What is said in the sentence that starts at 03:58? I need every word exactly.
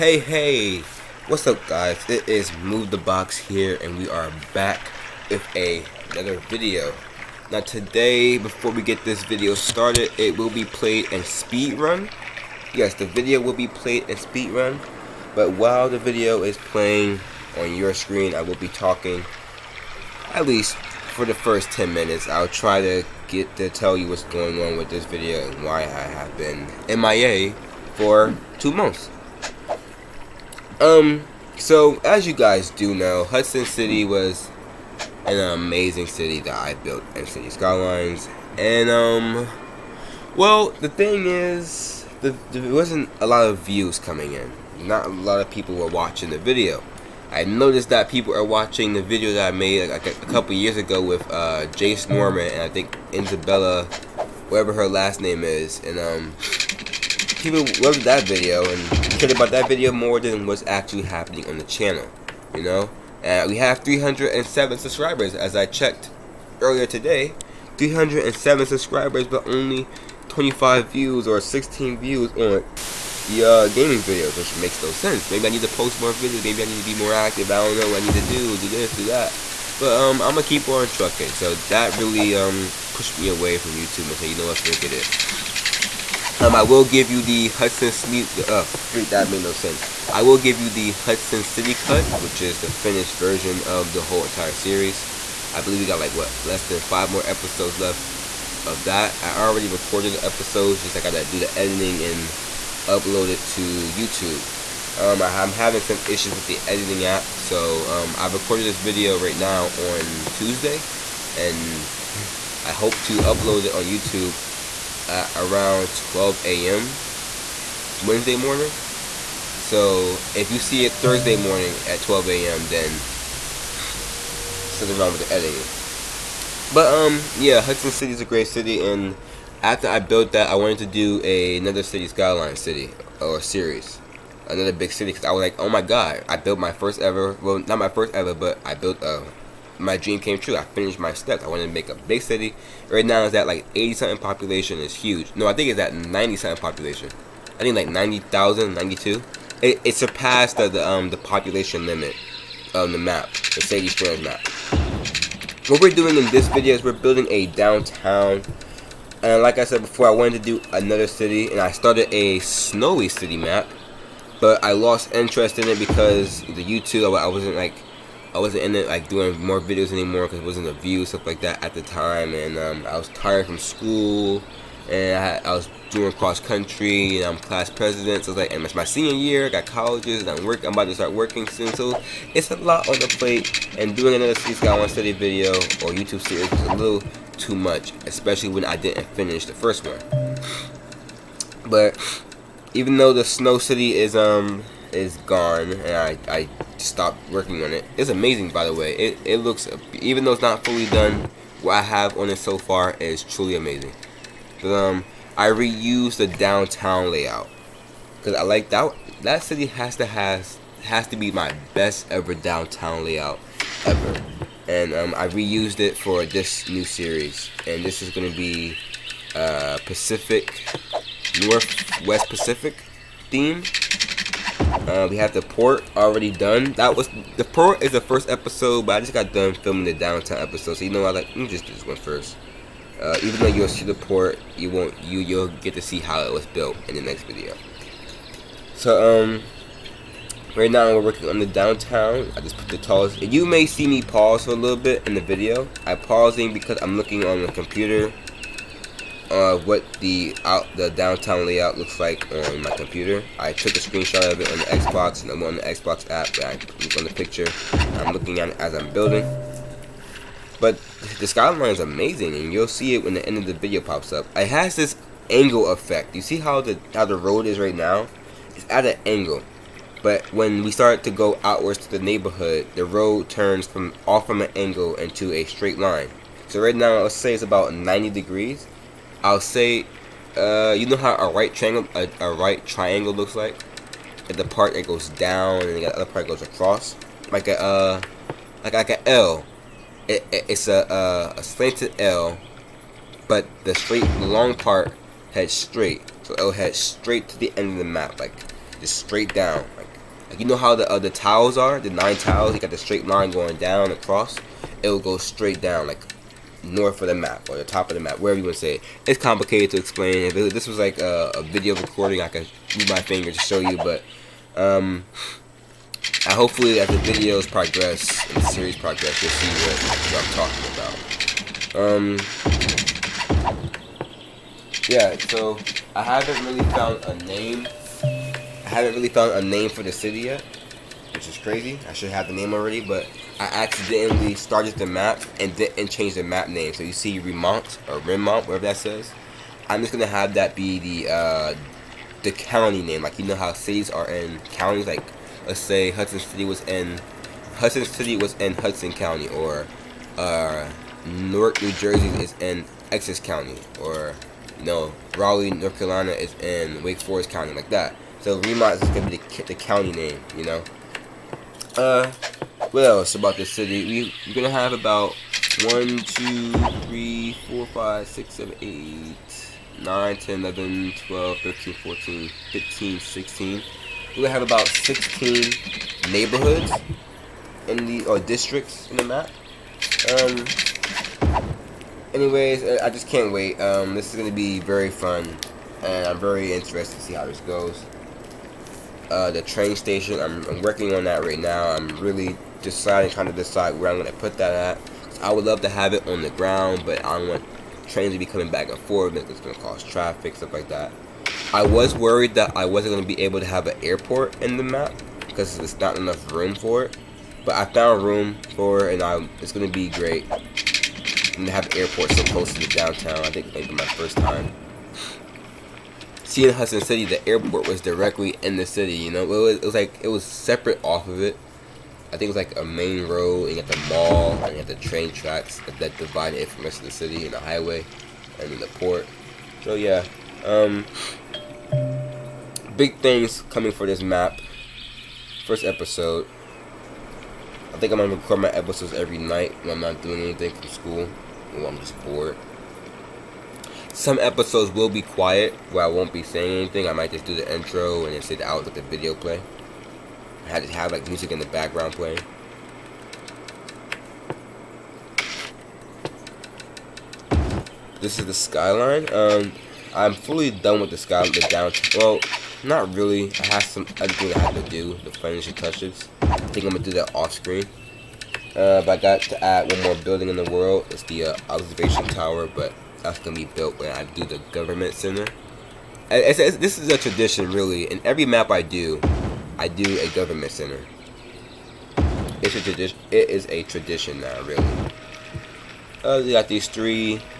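So um, right now we're working on the downtown.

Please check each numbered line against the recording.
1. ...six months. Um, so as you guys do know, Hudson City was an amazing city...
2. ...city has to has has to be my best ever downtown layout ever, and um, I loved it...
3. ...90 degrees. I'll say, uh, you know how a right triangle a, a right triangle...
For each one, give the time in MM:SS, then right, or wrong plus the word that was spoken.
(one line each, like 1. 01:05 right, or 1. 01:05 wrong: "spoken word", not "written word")
1. 00:28 wrong: "two", not "six"
2. 03:29 wrong: "reused", not "loved"
3. 04:37 right.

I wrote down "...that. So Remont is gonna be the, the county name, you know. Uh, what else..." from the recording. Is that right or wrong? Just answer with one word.
right.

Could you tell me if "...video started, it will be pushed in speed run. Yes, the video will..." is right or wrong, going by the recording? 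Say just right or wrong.
wrong.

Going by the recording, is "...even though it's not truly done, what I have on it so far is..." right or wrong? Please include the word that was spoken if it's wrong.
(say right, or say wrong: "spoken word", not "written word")
wrong: "fully", not "truly".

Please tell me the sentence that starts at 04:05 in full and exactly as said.
I'm pausing because I'm looking on the computer uh, what the out the downtown layout looks like on my computer.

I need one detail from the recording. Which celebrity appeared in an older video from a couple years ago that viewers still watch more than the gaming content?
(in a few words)
Jace Norman.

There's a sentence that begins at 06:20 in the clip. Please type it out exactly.
Um, anyways, I just can't wait.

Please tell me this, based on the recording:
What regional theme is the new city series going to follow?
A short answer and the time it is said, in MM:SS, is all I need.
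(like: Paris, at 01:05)
Pacific Northwest, at 03:39.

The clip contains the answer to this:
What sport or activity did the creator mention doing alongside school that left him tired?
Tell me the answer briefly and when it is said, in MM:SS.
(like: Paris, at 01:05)
cross country, at 02:56.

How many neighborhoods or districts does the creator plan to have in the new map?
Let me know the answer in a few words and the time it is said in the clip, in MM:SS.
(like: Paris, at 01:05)
16, at 06:14.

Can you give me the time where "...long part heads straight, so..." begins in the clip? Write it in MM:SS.
04:54.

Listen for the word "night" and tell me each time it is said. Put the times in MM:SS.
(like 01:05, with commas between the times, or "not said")
07:19.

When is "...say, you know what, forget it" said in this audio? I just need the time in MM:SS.
01:24.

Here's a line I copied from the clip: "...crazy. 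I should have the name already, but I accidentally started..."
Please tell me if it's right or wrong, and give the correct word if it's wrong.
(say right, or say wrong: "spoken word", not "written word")
right.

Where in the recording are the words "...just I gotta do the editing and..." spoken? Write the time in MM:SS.
01:40.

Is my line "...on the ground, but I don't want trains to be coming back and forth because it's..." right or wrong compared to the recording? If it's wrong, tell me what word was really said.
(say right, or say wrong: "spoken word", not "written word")
right.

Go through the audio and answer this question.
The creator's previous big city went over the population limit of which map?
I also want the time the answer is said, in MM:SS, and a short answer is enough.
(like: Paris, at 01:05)
Sadie Square, at 02:33.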